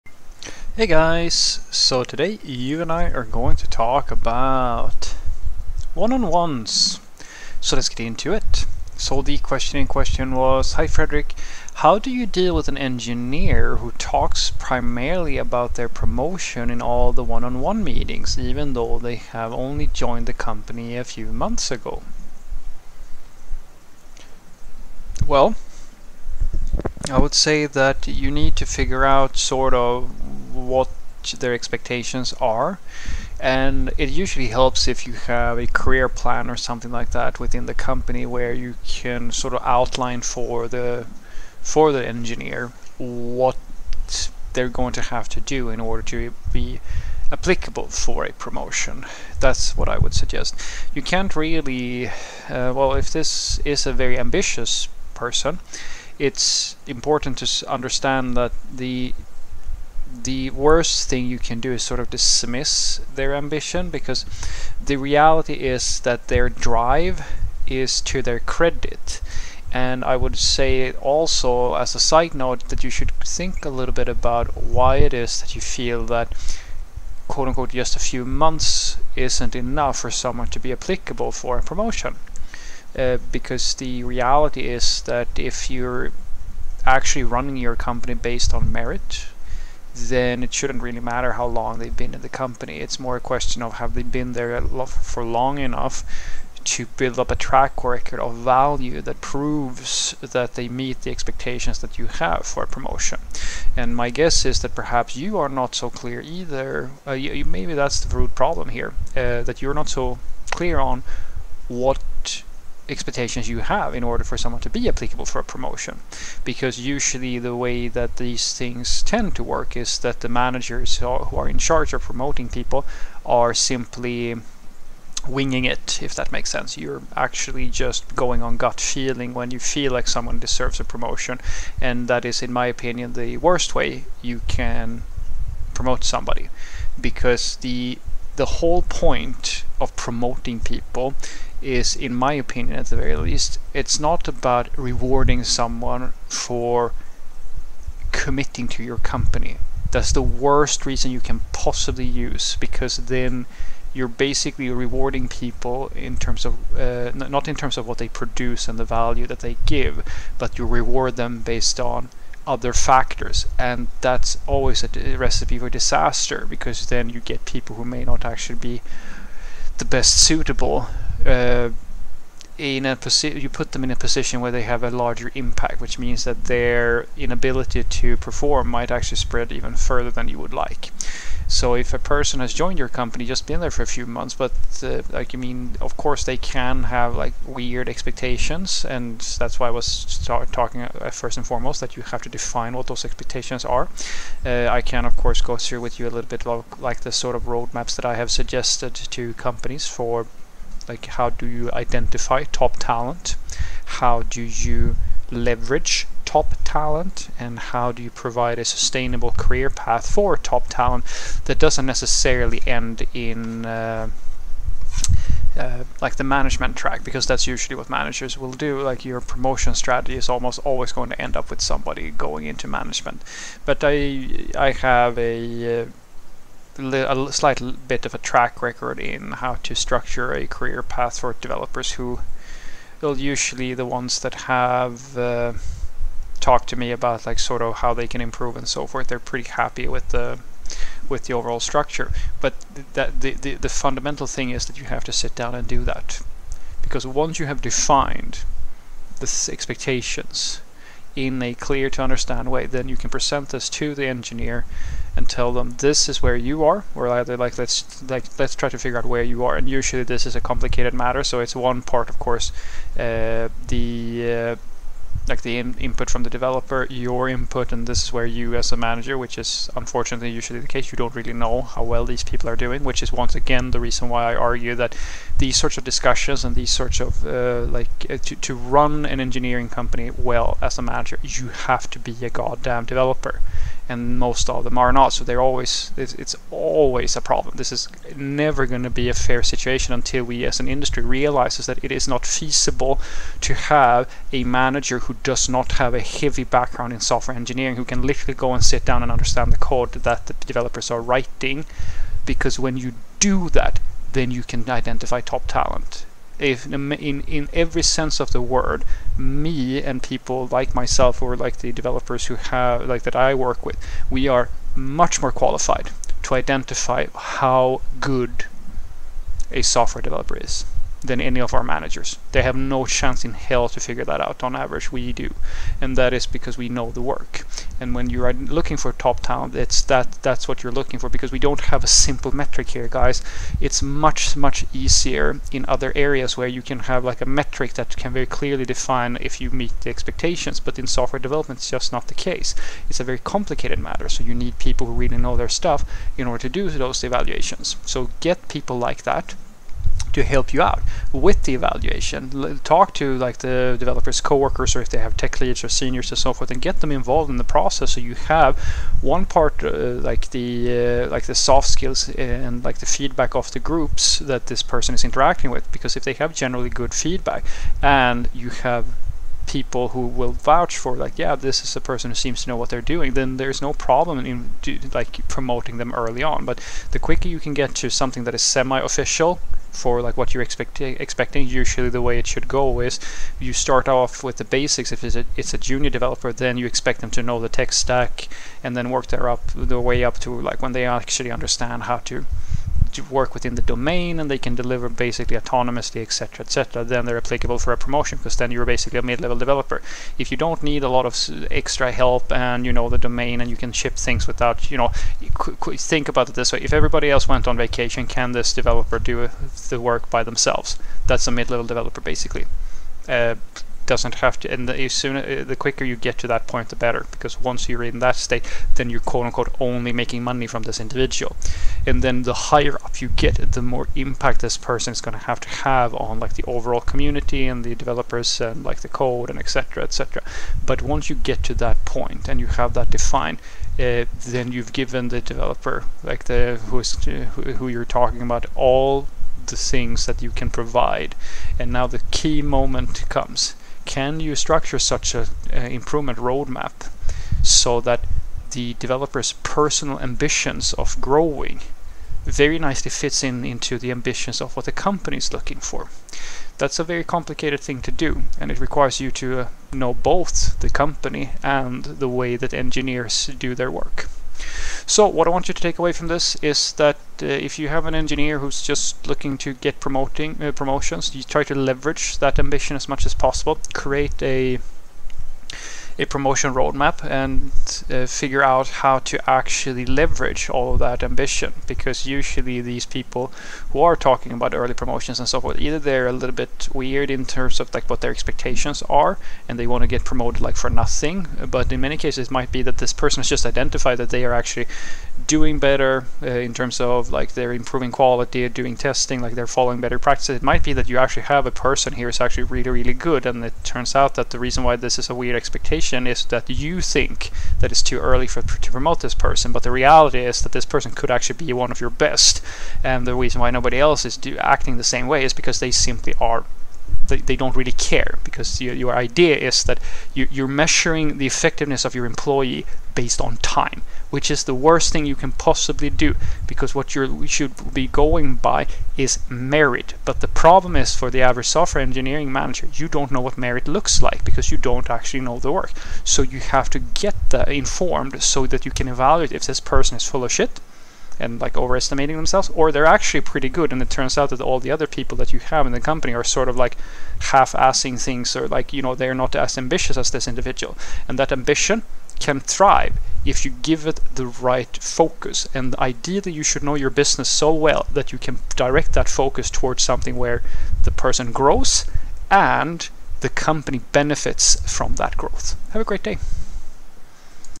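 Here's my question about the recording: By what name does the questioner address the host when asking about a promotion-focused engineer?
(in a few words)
Fredrik.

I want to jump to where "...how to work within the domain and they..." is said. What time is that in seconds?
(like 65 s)
391 s.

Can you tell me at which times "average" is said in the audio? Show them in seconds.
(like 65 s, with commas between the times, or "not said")
324 s, 531 s.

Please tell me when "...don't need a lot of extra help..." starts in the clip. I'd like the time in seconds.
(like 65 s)
400 s.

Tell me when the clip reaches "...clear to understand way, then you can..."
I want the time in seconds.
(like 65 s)
251 s.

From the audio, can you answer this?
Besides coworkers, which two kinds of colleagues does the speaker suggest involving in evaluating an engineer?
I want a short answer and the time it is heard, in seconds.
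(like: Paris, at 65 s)
tech leads or seniors, at 355 s.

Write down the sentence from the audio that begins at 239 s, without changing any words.
They're pretty happy with the with the overall structure.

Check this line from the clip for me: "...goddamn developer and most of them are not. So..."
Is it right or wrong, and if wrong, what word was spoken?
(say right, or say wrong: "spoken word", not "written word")
right.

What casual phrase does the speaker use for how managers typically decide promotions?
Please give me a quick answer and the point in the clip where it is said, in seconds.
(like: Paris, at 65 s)
winging it, at 125 s.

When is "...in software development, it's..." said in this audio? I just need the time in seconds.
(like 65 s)
340 s.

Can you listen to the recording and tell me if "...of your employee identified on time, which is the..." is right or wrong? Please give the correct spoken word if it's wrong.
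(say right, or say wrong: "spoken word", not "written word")
wrong: "based", not "identified".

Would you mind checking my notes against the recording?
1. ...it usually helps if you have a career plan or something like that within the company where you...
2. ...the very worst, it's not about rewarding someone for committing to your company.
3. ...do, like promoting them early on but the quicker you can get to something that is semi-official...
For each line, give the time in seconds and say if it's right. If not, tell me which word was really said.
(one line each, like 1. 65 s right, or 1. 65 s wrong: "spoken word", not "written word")
1. 34 s right
2. 142 s wrong: "least", not "worst"
3. 374 s right.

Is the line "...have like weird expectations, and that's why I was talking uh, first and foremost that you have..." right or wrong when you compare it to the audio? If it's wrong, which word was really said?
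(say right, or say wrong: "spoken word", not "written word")
right.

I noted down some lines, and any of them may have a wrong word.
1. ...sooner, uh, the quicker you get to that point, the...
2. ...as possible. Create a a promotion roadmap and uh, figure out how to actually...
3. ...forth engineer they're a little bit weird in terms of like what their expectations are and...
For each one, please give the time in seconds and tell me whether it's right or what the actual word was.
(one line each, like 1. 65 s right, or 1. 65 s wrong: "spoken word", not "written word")
1. 414 s right
2. 473 s right
3. 485 s wrong: "either", not "engineer".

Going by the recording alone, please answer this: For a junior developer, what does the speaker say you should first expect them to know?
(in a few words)
the tech stack.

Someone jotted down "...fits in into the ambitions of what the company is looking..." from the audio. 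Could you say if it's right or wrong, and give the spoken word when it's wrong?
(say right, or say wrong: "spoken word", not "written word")
right.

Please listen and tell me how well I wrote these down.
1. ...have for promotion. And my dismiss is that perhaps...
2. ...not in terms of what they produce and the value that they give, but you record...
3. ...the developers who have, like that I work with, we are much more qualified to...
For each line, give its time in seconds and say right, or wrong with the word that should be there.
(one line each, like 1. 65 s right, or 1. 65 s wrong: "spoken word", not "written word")
1. 102 s wrong: "guess", not "dismiss"
2. 157 s wrong: "reward", not "record"
3. 311 s right.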